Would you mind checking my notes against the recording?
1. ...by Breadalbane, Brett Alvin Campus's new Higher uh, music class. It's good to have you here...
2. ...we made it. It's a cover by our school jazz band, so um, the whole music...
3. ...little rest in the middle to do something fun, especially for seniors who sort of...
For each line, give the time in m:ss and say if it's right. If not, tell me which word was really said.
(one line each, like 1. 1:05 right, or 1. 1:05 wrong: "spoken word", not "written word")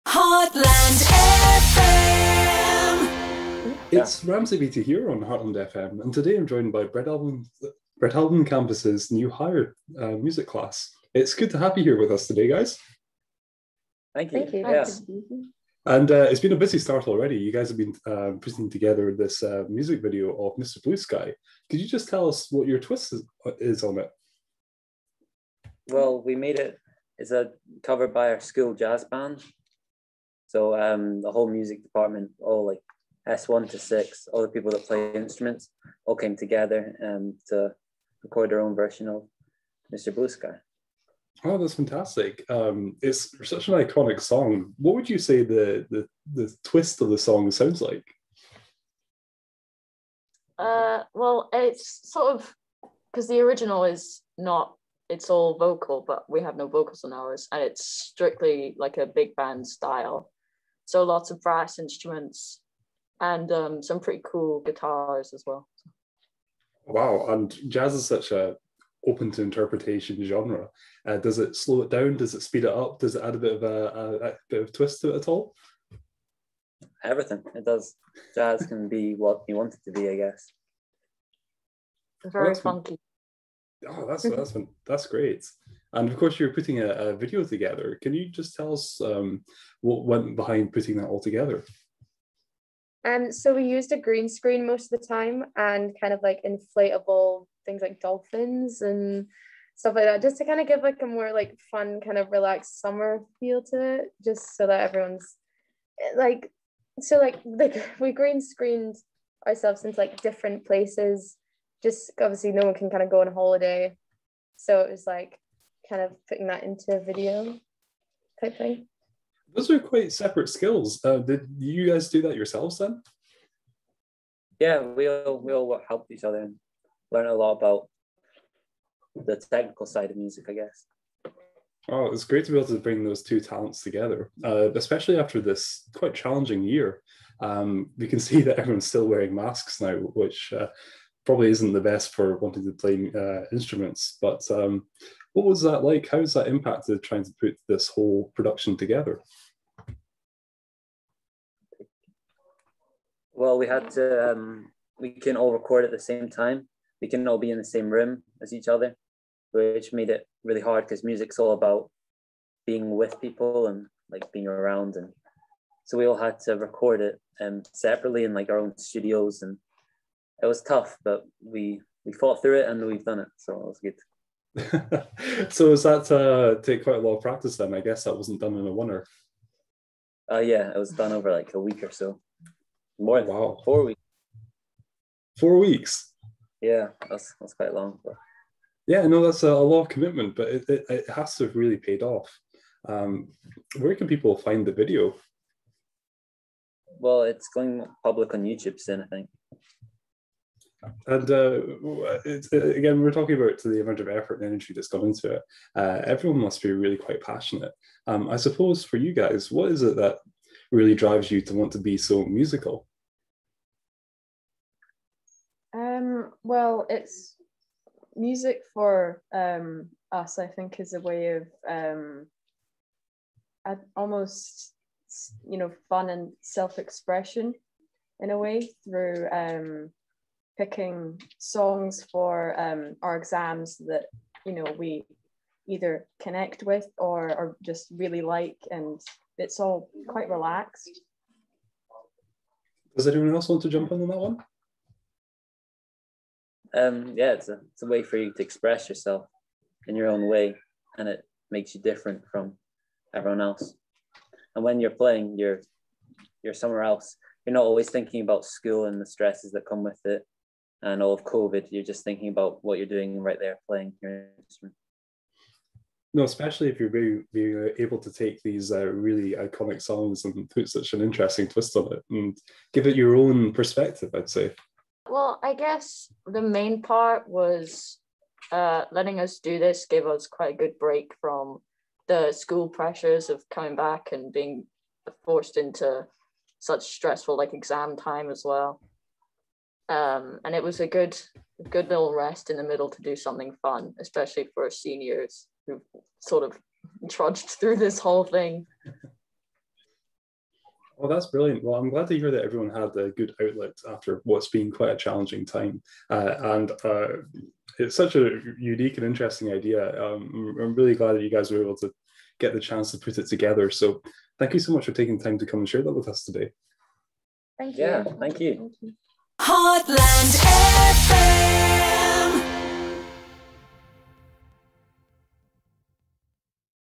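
1. 0:06 right
2. 0:26 right
3. 4:51 right.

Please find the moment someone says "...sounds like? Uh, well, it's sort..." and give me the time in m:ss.
0:47.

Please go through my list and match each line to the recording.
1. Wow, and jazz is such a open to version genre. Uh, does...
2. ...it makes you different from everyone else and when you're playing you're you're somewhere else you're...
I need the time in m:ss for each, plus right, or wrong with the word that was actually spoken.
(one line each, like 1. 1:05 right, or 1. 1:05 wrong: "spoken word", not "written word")
1. 1:06 wrong: "interpretation", not "version"
2. 4:11 right.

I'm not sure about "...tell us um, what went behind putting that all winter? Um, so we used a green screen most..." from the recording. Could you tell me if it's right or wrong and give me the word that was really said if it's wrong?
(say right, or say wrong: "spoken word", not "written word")
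wrong: "together", not "winter".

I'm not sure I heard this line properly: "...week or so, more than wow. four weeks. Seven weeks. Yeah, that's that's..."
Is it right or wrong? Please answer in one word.
wrong.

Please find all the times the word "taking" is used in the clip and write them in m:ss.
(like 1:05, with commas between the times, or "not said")
5:14.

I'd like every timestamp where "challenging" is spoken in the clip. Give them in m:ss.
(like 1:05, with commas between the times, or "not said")
2:16, 5:04.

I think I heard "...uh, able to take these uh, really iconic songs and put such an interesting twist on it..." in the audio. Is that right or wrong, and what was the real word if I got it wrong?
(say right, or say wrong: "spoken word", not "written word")
right.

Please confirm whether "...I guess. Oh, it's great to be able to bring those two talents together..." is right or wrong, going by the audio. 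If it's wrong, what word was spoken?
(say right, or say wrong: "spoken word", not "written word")
right.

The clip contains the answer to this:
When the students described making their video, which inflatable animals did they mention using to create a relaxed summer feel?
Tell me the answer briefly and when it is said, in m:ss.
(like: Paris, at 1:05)
Dolphins, at 1:37.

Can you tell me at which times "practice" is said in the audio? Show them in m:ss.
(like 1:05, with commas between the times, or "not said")
2:57.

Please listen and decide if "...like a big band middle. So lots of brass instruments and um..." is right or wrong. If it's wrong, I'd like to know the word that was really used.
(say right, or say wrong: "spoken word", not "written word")
wrong: "style", not "middle".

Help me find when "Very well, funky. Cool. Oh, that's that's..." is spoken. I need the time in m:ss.
1:22.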